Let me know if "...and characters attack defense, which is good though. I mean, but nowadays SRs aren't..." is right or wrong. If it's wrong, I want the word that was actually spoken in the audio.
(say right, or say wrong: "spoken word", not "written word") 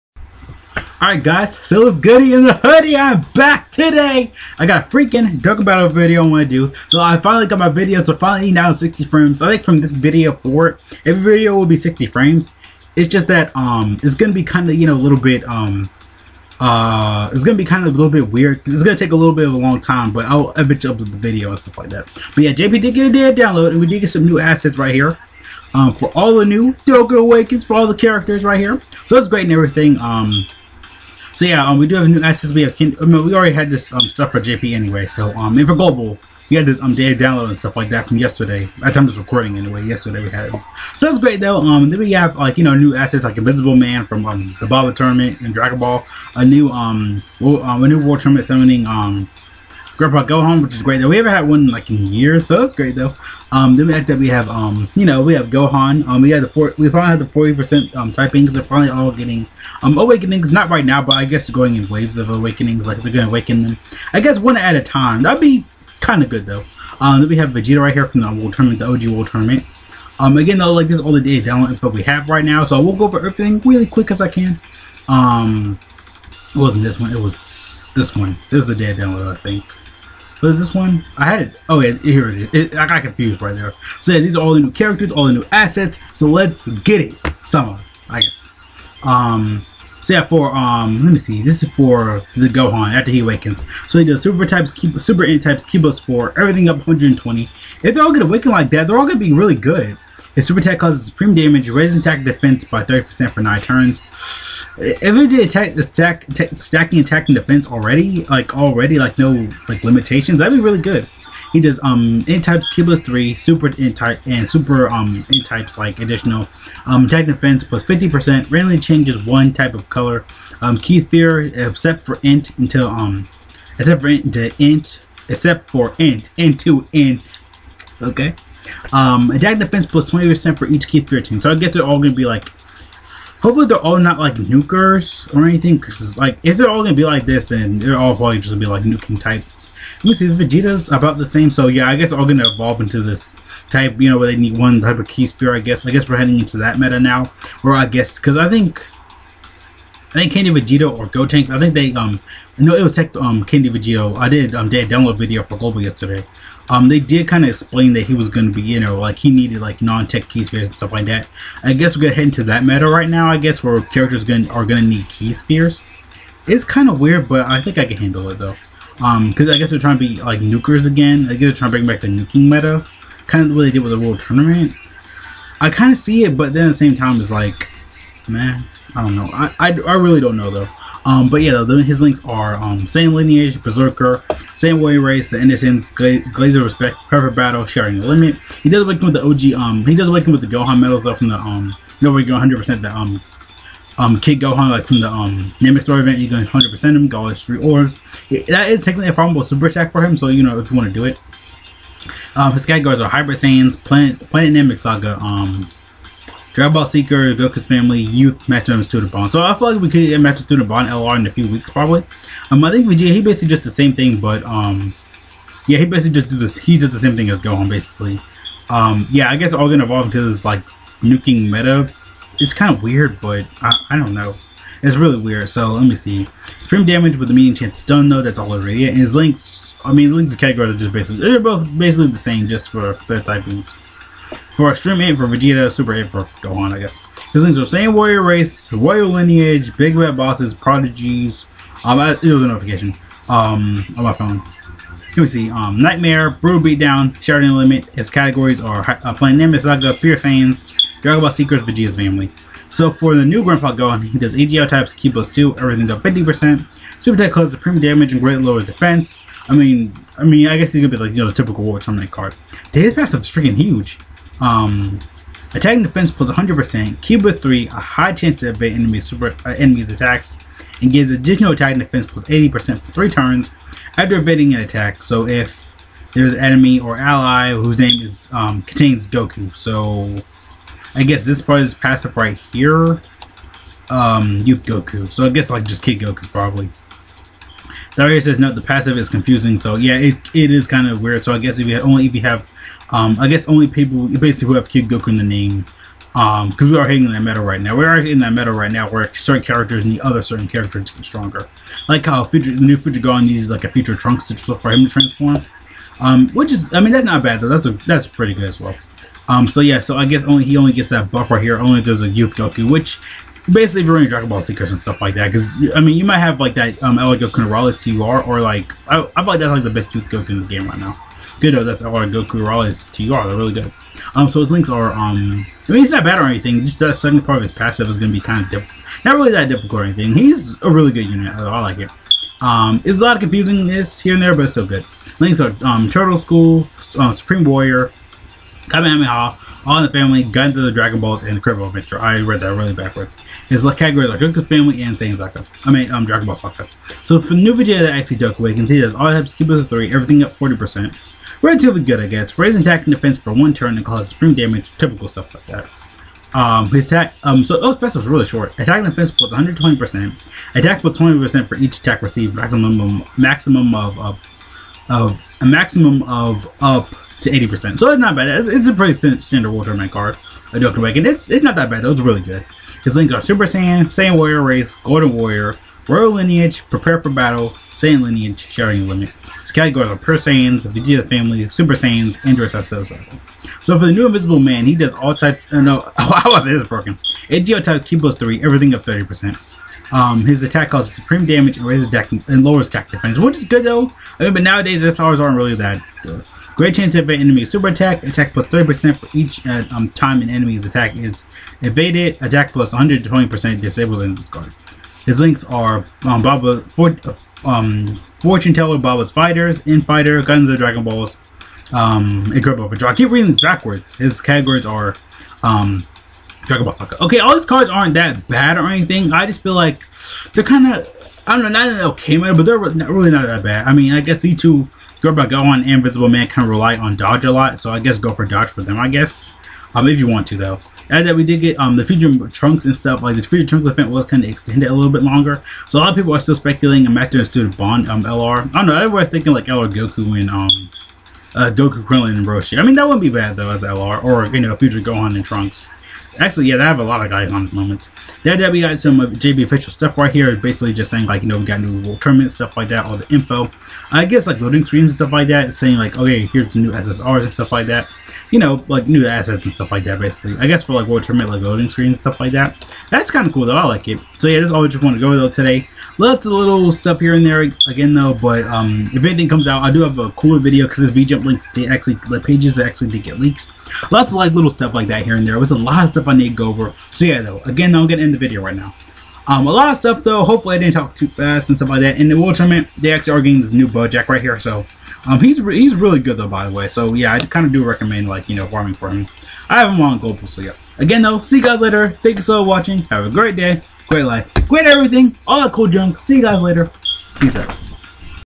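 wrong: "lowers", not "characters".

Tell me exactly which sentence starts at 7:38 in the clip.
You know like new assets and stuff like that.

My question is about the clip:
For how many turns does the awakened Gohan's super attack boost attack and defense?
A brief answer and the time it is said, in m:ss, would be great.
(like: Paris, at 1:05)
9, at 1:43.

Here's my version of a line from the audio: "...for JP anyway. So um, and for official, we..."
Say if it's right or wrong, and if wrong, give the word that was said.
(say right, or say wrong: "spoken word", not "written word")
wrong: "global", not "official".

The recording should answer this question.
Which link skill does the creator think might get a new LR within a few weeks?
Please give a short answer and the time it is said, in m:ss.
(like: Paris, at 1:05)
Master and Student Bond, at 3:30.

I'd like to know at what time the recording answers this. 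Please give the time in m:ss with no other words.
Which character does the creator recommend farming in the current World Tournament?
8:03.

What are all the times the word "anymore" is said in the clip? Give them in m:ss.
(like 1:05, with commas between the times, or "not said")
not said.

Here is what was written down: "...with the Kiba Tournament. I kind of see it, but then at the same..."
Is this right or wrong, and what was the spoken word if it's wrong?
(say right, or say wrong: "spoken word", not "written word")
wrong: "World", not "Kiba".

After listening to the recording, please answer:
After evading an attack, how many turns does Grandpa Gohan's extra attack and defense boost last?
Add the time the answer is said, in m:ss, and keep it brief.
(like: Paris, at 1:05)
3, at 4:32.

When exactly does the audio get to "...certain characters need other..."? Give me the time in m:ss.
4:59.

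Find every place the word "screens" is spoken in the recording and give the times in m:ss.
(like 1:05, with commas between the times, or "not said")
7:34, 7:41.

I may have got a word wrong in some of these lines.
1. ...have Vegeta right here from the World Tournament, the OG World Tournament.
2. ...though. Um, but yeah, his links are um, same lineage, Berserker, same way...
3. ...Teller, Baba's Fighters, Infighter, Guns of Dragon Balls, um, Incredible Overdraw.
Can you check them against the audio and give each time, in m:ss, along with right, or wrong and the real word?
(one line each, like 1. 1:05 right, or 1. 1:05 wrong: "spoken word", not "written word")
1. 1:07 right
2. 3:00 right
3. 6:48 right.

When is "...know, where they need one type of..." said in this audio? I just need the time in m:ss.
2:24.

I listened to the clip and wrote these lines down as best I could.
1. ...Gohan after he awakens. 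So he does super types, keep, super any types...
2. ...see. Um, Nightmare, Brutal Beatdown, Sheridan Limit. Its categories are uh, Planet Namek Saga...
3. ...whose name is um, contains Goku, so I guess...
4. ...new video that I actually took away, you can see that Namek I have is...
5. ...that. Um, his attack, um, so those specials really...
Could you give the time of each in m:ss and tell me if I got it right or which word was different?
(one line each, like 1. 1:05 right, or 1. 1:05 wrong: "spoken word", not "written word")
1. 1:32 right
2. 4:05 right
3. 4:37 right
4. 5:47 wrong: "All", not "Namek"
5. 5:55 right.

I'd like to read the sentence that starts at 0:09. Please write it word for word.
I think from this video forward, every video will be 60 frames.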